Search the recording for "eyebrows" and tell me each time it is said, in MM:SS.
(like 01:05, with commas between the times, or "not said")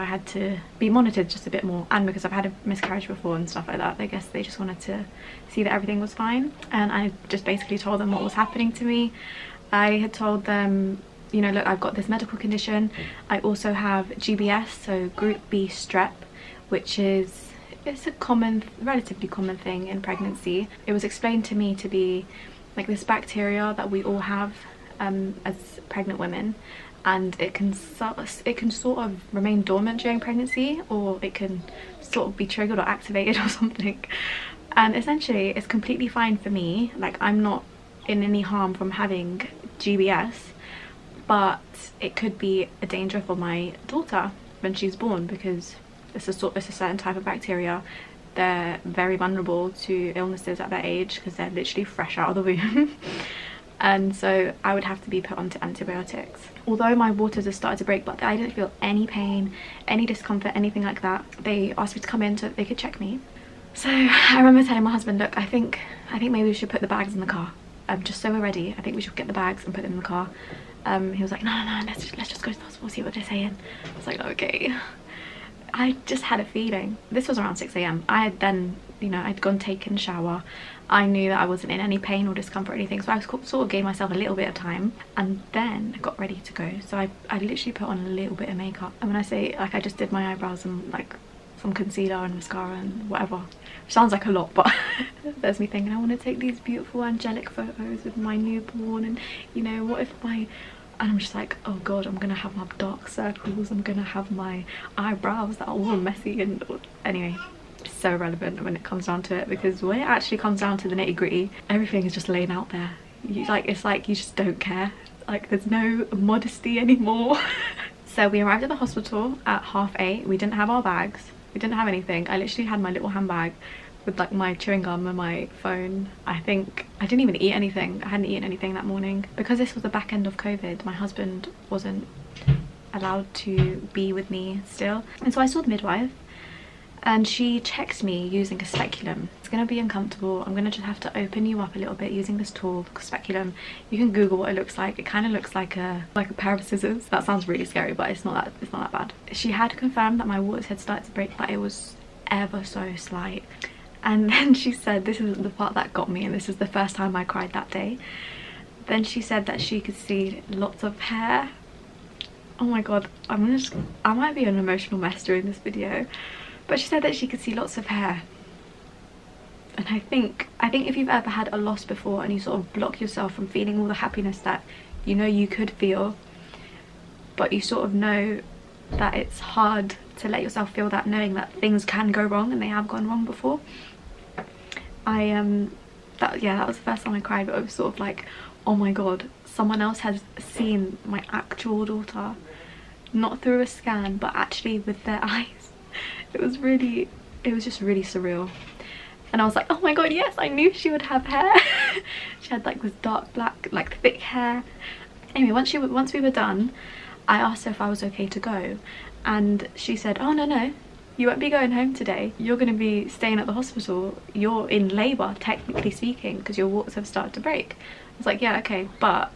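01:30, 01:44.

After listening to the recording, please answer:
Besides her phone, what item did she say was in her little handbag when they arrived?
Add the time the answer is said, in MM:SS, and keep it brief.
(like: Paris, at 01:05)
Chewing gum, at 02:04.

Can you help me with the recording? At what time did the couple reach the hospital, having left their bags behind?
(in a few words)
8:30.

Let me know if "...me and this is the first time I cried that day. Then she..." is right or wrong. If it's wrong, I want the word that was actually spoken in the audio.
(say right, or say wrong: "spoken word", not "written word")
right.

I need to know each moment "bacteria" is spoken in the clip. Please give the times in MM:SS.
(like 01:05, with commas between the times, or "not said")
00:23, 00:47.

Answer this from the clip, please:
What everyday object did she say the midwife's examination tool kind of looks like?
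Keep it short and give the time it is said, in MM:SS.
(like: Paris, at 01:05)
A pair of scissors, at 02:26.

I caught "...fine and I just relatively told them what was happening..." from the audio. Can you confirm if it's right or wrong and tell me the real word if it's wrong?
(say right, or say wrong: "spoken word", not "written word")
wrong: "basically", not "relatively".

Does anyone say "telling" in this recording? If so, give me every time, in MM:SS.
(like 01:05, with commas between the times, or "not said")
01:04.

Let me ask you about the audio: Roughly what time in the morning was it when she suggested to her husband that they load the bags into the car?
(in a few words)
6am.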